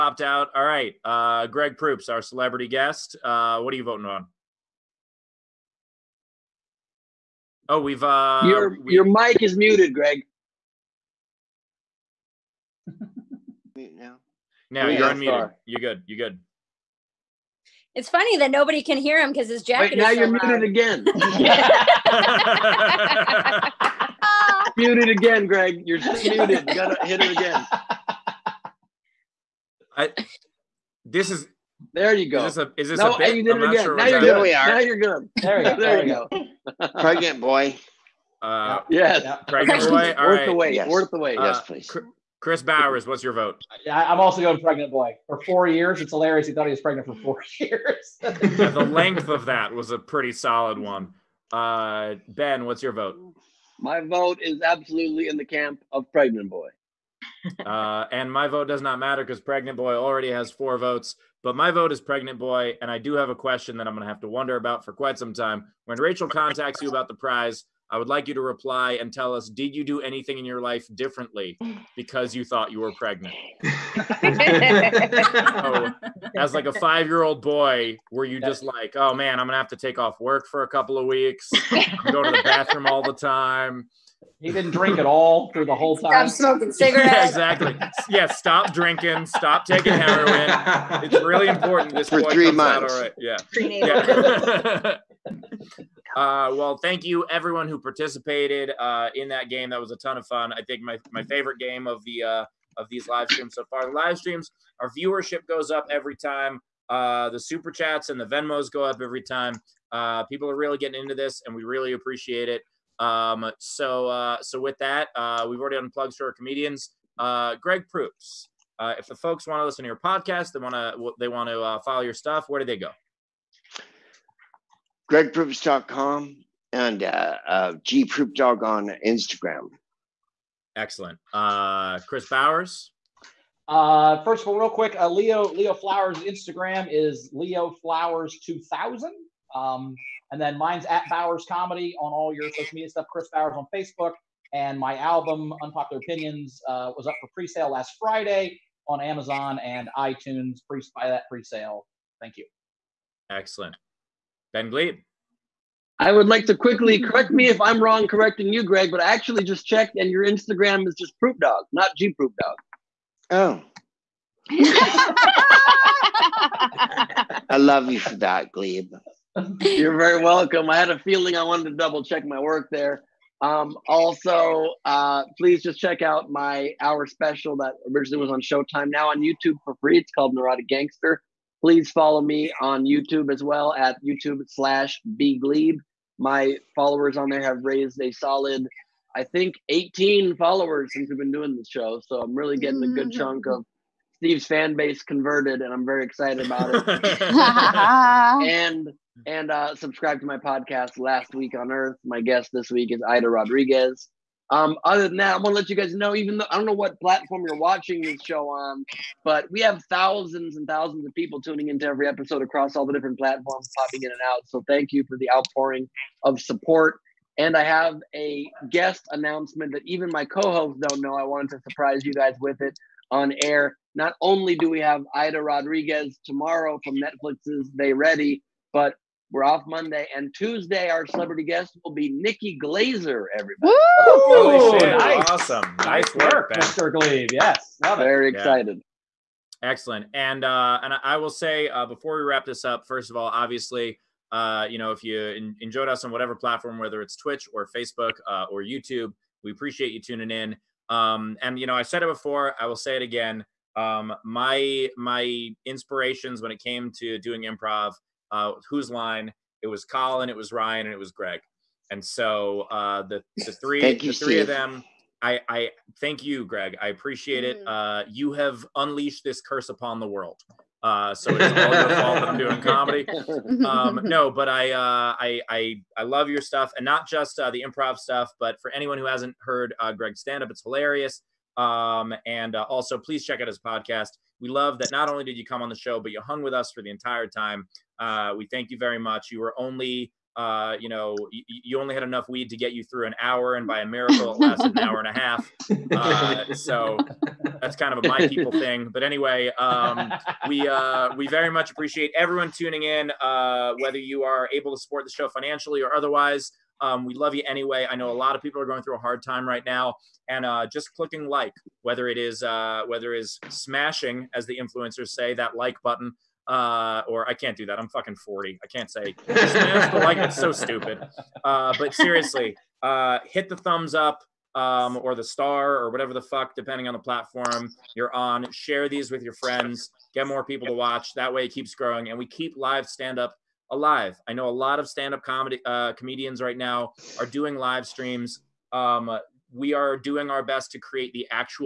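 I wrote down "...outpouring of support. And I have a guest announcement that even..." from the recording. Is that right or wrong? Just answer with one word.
right.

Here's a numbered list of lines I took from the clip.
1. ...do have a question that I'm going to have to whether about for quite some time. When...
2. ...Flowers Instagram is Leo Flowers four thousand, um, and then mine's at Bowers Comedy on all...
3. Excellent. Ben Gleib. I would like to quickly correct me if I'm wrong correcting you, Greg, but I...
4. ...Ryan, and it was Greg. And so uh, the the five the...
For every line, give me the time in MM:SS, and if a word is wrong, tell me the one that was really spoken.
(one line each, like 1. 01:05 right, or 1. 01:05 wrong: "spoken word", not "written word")
1. 01:02 wrong: "wonder", not "whether"
2. 02:15 wrong: "two", not "four"
3. 02:33 right
4. 04:20 wrong: "three", not "five".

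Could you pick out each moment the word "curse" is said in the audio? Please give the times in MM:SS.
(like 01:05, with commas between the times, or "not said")
04:29.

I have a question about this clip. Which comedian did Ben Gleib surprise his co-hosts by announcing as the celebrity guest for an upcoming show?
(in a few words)
Nikki Glazer.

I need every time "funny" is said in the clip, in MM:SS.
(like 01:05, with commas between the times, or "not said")
00:18.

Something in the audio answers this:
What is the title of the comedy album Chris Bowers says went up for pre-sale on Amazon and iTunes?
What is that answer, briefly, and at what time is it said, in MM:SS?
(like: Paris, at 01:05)
Unpopular Opinions, at 02:25.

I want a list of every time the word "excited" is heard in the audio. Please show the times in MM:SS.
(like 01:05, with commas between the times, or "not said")
03:16, 03:58.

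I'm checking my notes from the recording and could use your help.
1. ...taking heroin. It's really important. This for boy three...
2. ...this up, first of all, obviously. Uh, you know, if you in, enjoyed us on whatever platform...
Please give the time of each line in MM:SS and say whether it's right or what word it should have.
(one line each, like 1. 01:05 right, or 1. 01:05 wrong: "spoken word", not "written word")
1. 01:29 right
2. 04:02 right.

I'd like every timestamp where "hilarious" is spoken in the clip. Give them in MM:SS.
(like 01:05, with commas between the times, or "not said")
00:46, 04:40.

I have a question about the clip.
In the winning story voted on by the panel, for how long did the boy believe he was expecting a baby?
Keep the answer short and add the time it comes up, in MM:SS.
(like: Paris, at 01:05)
4 years, at 00:45.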